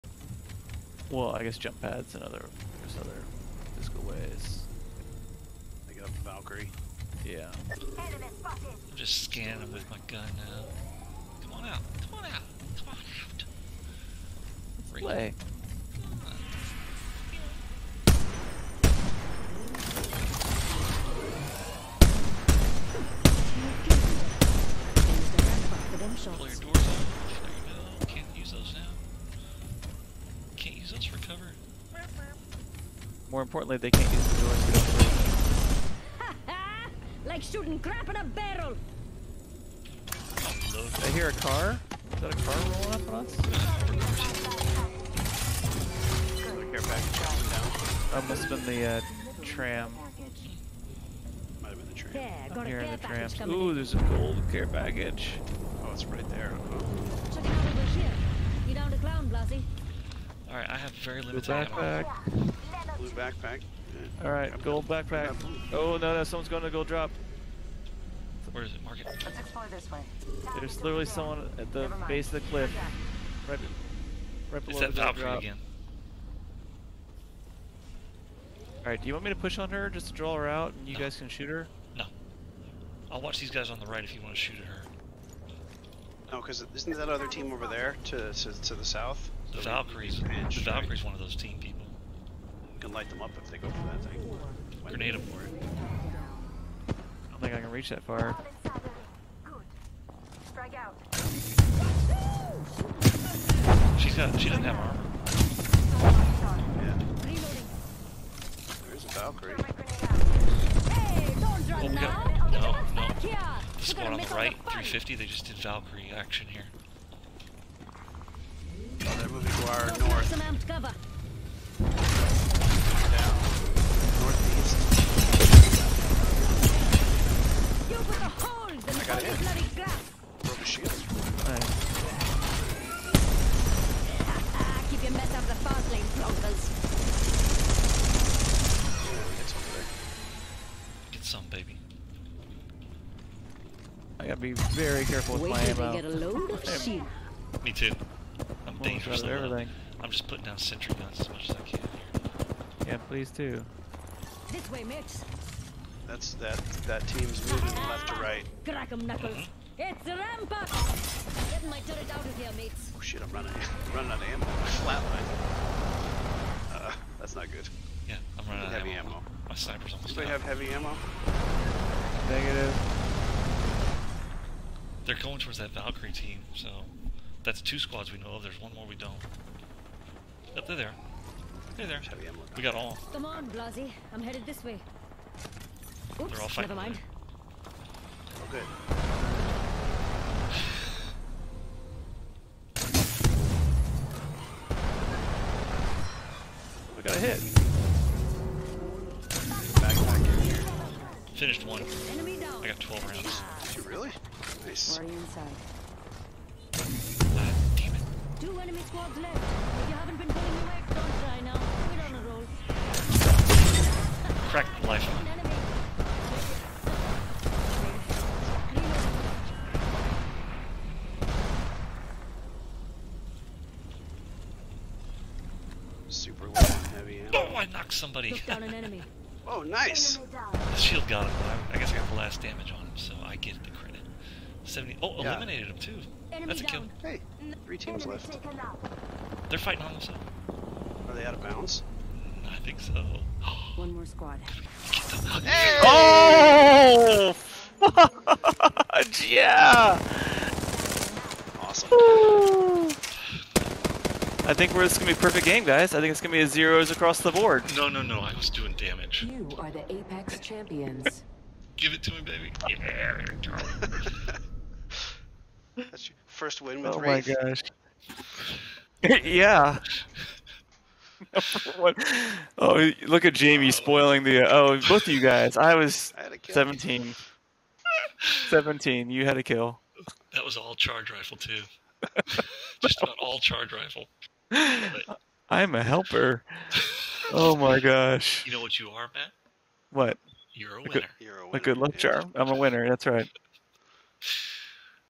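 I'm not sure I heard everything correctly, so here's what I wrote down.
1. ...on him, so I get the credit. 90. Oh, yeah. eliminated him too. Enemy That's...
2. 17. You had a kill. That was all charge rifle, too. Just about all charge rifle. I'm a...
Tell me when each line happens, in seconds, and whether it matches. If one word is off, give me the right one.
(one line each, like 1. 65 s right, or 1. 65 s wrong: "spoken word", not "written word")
1. 232 s wrong: "70", not "90"
2. 278 s right.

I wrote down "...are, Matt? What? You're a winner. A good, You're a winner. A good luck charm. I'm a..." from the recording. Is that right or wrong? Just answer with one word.
right.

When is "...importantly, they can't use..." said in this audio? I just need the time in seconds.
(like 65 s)
33 s.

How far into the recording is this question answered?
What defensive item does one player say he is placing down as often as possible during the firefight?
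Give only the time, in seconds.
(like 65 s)
150 s.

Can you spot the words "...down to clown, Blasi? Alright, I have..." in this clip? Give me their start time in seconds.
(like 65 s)
58 s.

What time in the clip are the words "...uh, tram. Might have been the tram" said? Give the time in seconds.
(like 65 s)
48 s.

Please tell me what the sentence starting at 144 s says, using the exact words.
I gotta be very careful with Wait my ammo.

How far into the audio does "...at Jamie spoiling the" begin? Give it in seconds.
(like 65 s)
273 s.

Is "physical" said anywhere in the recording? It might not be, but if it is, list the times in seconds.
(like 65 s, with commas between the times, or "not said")
3 s.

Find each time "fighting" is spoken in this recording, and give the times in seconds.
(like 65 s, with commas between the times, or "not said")
186 s, 239 s.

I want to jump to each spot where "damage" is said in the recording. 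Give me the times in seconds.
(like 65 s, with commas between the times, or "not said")
232 s, 258 s.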